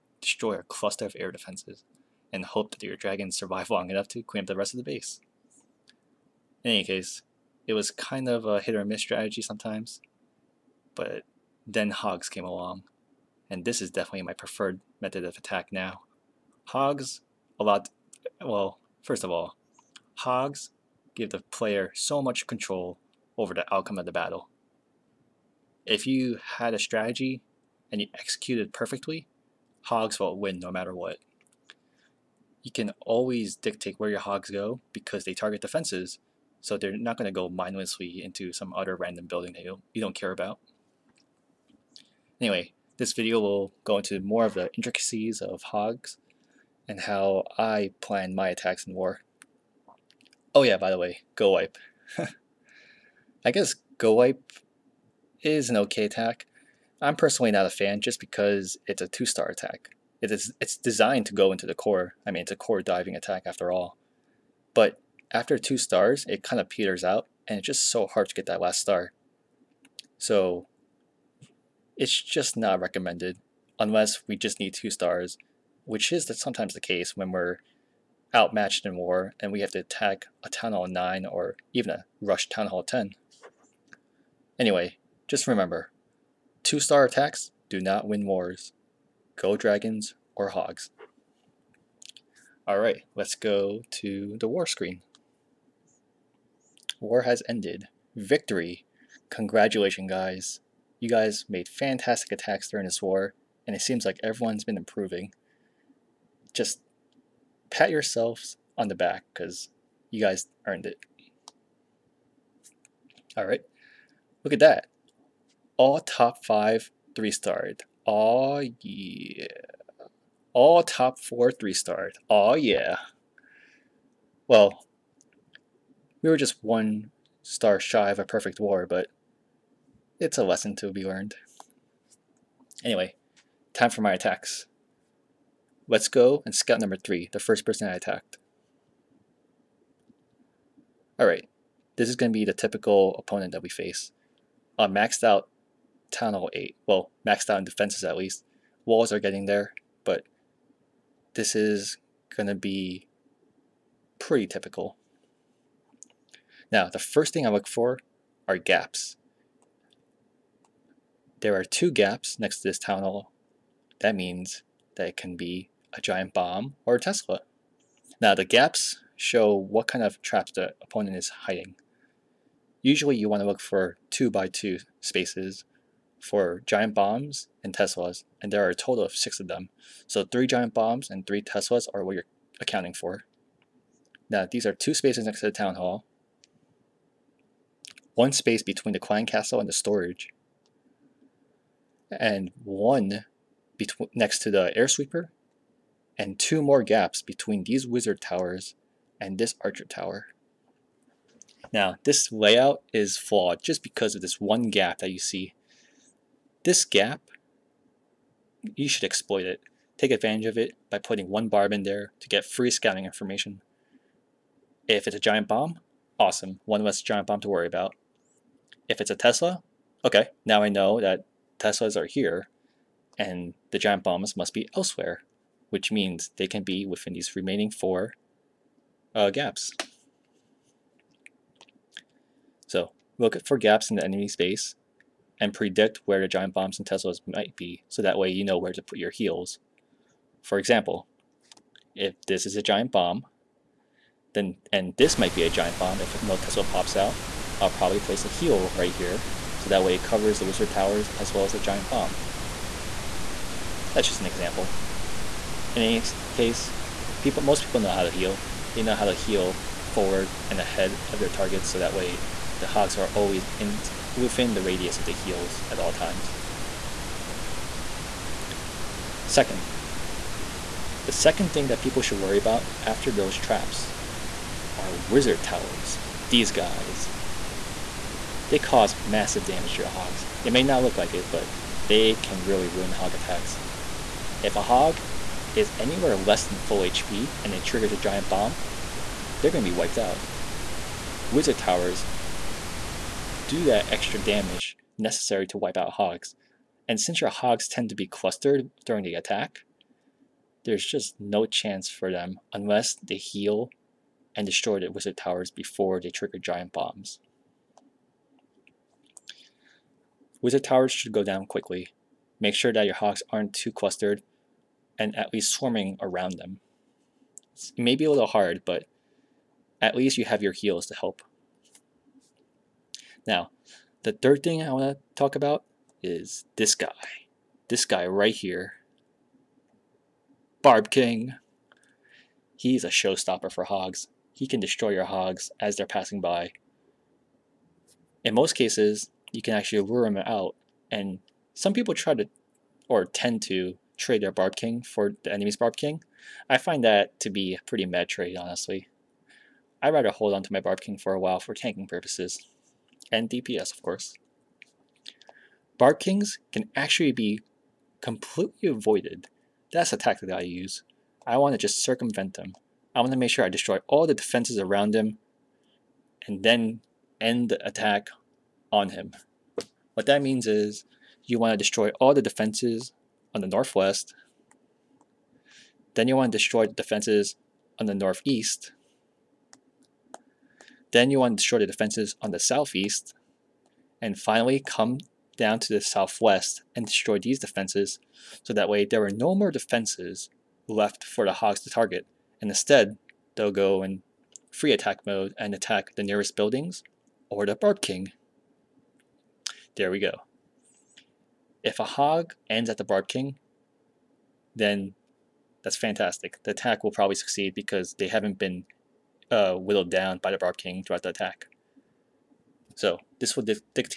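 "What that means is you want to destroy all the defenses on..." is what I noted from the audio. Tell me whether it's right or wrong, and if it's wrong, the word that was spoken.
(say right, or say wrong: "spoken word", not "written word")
right.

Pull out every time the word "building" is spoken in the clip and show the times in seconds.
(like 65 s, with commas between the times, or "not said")
39 s, 396 s.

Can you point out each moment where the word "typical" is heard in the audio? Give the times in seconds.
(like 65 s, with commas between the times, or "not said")
142 s, 154 s.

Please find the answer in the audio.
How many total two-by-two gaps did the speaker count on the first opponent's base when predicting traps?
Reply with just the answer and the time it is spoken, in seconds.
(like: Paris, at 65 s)
6, at 179 s.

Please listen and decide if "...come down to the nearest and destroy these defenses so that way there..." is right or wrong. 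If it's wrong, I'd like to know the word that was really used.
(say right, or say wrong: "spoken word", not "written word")
wrong: "southwest", not "nearest".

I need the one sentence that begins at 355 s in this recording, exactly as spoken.
Barb Kings can actually be completely avoided.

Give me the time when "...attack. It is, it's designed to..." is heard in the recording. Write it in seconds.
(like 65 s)
59 s.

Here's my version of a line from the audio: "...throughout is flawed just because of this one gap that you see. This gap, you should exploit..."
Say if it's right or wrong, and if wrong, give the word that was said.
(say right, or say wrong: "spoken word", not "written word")
wrong: "layout", not "throughout".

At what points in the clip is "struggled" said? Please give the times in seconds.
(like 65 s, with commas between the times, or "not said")
not said.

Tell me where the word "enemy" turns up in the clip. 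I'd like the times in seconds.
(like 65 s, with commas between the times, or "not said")
234 s, 345 s.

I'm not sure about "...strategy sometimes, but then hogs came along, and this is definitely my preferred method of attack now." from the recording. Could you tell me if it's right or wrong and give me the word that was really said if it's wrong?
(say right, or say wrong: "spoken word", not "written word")
right.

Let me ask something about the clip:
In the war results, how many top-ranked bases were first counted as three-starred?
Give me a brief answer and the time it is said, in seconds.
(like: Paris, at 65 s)
5, at 116 s.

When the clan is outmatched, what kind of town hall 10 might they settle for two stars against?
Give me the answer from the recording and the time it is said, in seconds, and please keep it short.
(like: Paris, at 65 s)
a rush town hall 10, at 82 s.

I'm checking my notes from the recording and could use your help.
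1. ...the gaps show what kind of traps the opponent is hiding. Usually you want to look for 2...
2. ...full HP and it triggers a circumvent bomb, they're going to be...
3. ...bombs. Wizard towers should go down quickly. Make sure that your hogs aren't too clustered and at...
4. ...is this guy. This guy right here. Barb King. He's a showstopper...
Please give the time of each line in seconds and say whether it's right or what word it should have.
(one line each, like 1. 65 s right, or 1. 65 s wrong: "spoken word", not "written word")
1. 168 s right
2. 286 s wrong: "giant", not "circumvent"
3. 306 s right
4. 326 s right.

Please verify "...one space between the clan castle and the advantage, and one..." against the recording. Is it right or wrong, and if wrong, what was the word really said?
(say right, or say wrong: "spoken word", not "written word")
wrong: "storage", not "advantage".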